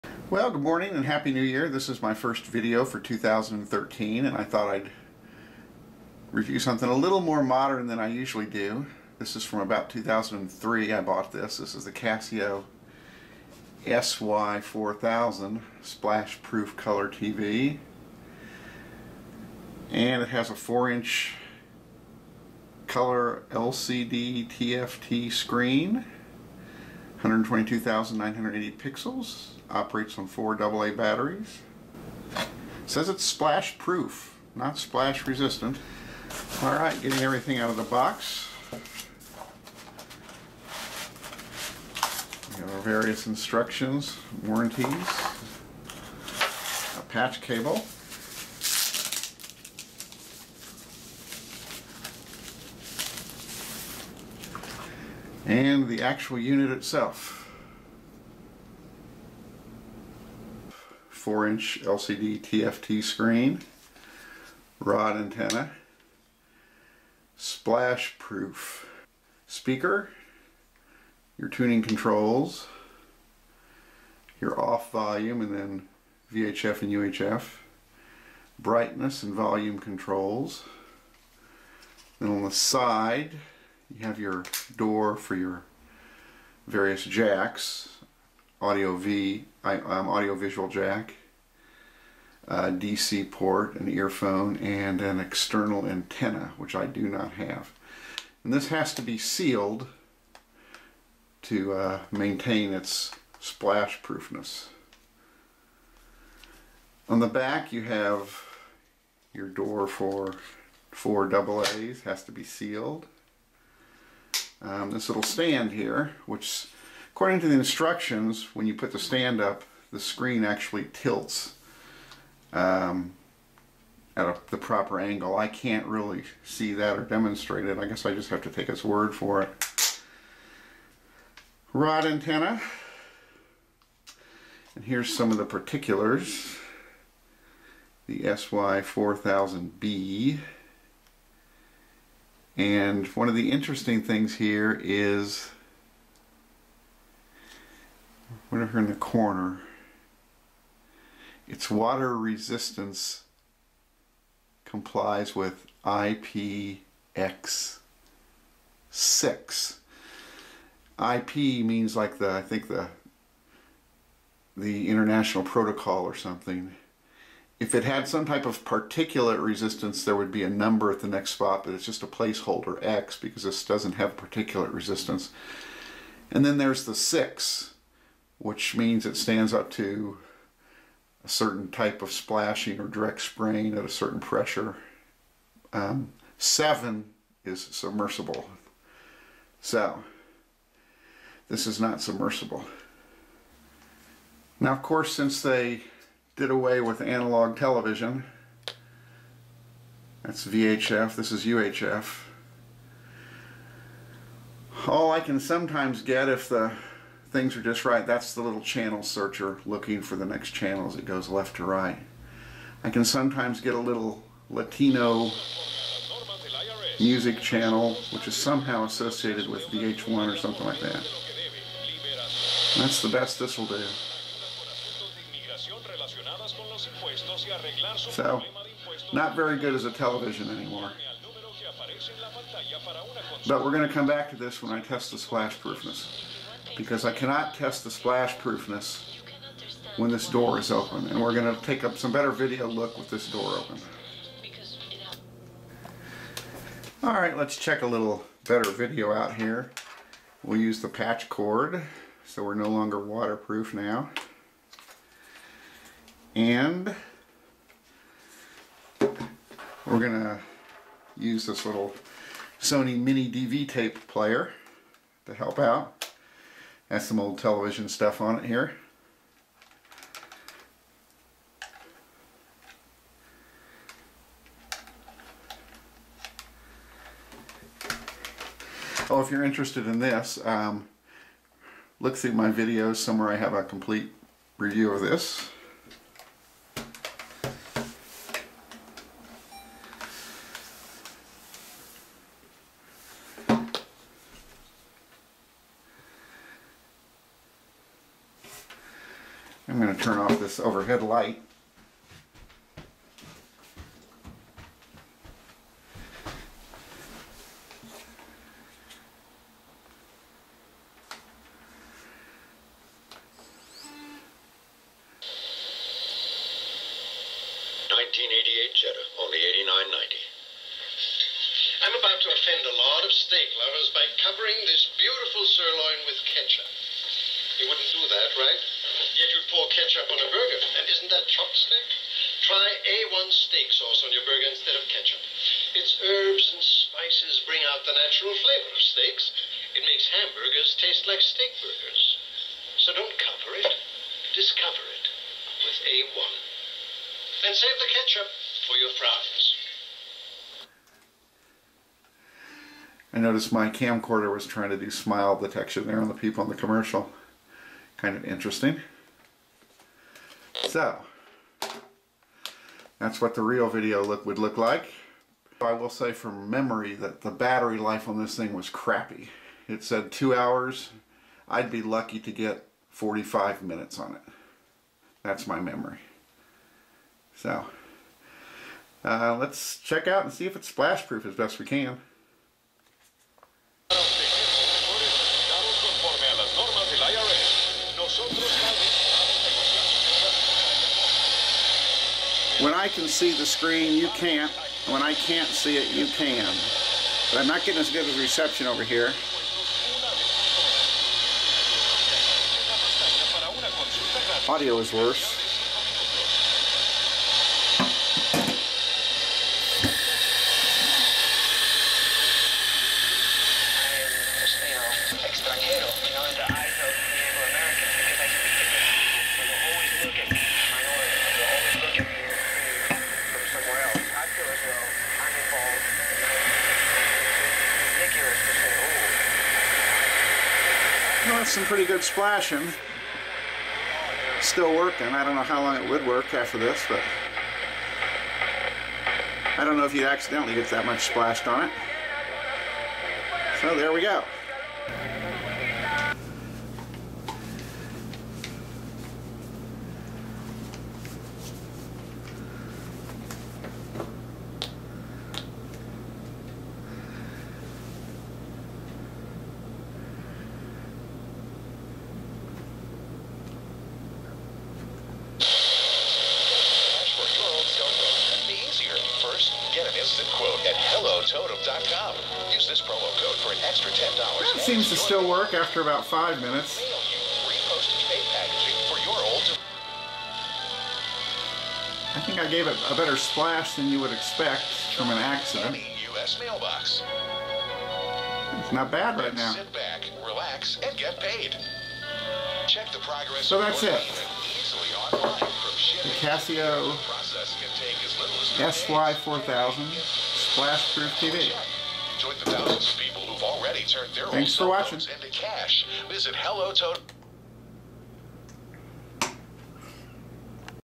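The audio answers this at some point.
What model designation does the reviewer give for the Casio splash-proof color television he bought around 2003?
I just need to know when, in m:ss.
0:11.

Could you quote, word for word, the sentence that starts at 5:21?
I'm about to offend a lot of steak lovers by covering this beautiful sirloin with ketchup.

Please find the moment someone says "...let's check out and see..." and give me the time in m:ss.
6:19.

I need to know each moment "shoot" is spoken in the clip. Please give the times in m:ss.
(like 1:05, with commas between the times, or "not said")
not said.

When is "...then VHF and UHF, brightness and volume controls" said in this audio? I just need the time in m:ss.
1:15.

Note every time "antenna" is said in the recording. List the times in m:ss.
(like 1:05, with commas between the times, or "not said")
1:05, 1:35, 2:12.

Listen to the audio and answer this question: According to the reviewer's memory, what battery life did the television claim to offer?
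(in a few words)
2 hours.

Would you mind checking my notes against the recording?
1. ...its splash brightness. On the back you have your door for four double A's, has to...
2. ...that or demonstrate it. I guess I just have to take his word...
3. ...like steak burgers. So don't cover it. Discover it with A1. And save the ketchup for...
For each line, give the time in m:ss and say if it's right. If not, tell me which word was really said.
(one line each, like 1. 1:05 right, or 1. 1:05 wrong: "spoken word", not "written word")
1. 1:42 wrong: "proofness", not "brightness"
2. 2:06 right
3. 5:41 right.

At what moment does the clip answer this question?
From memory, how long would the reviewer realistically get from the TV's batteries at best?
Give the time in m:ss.
6:12.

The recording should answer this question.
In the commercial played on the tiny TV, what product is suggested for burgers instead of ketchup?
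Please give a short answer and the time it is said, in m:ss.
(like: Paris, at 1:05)
A1 steak sauce, at 5:32.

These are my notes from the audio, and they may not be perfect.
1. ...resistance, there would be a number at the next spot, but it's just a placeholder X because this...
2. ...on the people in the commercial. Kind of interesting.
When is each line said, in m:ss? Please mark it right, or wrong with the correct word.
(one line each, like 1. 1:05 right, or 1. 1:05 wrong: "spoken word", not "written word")
1. 2:49 right
2. 5:56 right.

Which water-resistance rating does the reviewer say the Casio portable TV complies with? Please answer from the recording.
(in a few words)
IPX6.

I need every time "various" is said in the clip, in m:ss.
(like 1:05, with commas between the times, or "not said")
0:42, 1:26.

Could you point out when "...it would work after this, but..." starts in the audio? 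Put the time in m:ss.
7:15.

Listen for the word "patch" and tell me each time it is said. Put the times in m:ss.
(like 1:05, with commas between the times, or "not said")
0:47, 4:10.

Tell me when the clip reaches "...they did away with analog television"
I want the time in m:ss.
3:15.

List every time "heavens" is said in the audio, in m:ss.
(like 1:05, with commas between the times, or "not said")
not said.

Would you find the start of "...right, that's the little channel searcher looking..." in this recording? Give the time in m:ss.
3:27.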